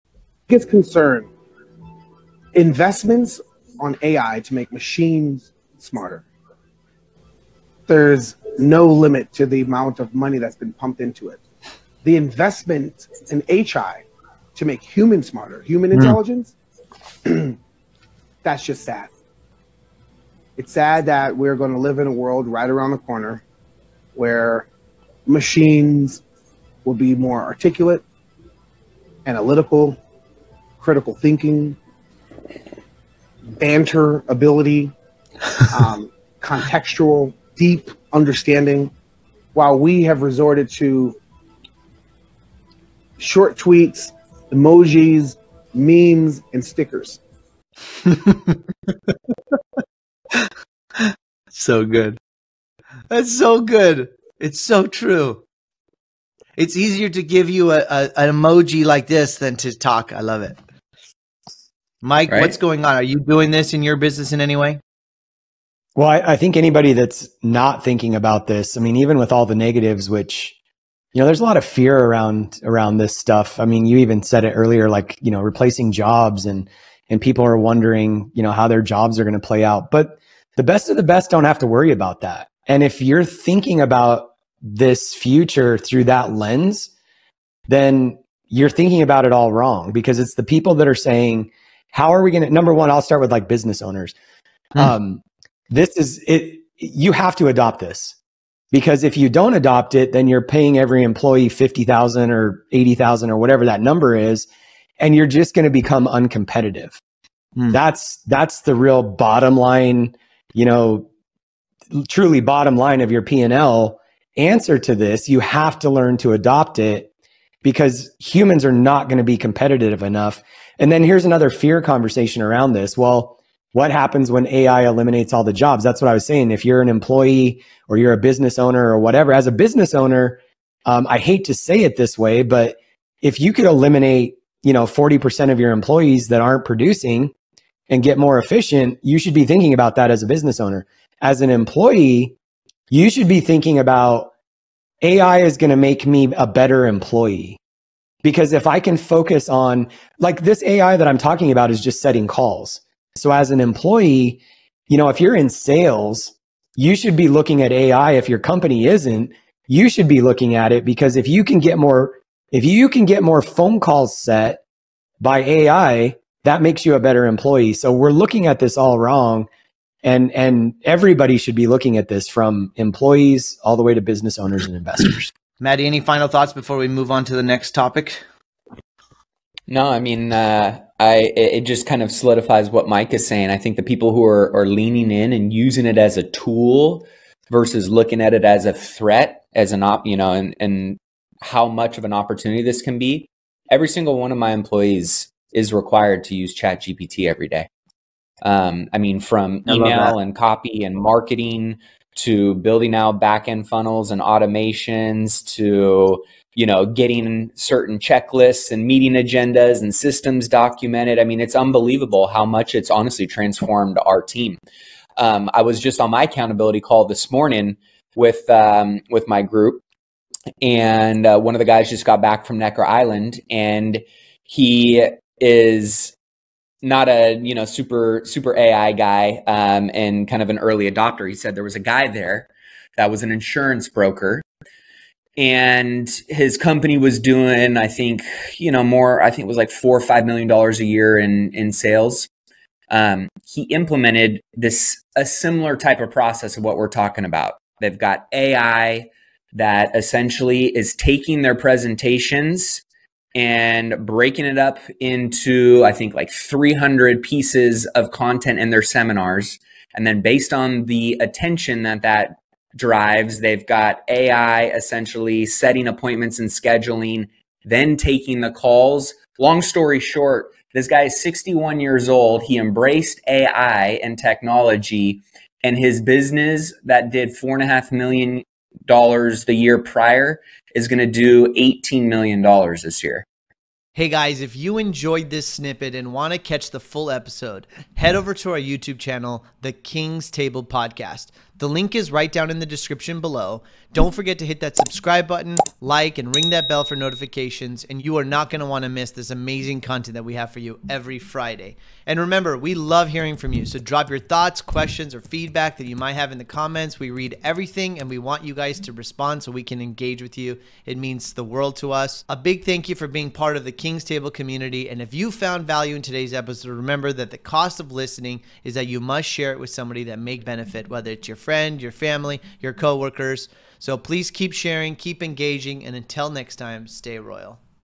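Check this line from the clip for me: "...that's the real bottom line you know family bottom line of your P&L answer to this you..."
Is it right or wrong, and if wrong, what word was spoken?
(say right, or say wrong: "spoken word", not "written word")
wrong: "truly", not "family".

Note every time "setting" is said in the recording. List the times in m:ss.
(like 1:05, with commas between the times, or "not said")
2:32, 4:25.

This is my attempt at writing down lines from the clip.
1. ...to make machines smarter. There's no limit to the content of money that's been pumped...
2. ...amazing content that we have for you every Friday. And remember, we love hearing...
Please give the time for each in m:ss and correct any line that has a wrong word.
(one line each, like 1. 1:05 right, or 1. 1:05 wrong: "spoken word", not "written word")
1. 0:04 wrong: "amount", not "content"
2. 4:59 right.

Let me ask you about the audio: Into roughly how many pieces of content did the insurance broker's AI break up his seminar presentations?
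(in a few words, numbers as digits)
300.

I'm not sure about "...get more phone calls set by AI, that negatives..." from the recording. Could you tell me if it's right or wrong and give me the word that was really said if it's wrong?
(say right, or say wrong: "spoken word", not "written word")
wrong: "makes", not "negatives".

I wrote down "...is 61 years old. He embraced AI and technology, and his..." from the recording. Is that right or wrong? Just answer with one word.
right.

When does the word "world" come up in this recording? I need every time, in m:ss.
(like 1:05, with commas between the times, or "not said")
0:22, 5:11.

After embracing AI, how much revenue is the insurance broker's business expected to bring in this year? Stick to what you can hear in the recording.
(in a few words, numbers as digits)
$18 million.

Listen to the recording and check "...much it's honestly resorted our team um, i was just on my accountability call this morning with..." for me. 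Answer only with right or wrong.
wrong.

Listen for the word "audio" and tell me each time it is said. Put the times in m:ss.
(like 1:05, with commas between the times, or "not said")
not said.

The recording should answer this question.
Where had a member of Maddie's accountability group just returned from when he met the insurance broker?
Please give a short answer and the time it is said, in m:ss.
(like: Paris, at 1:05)
Necker Island, at 3:42.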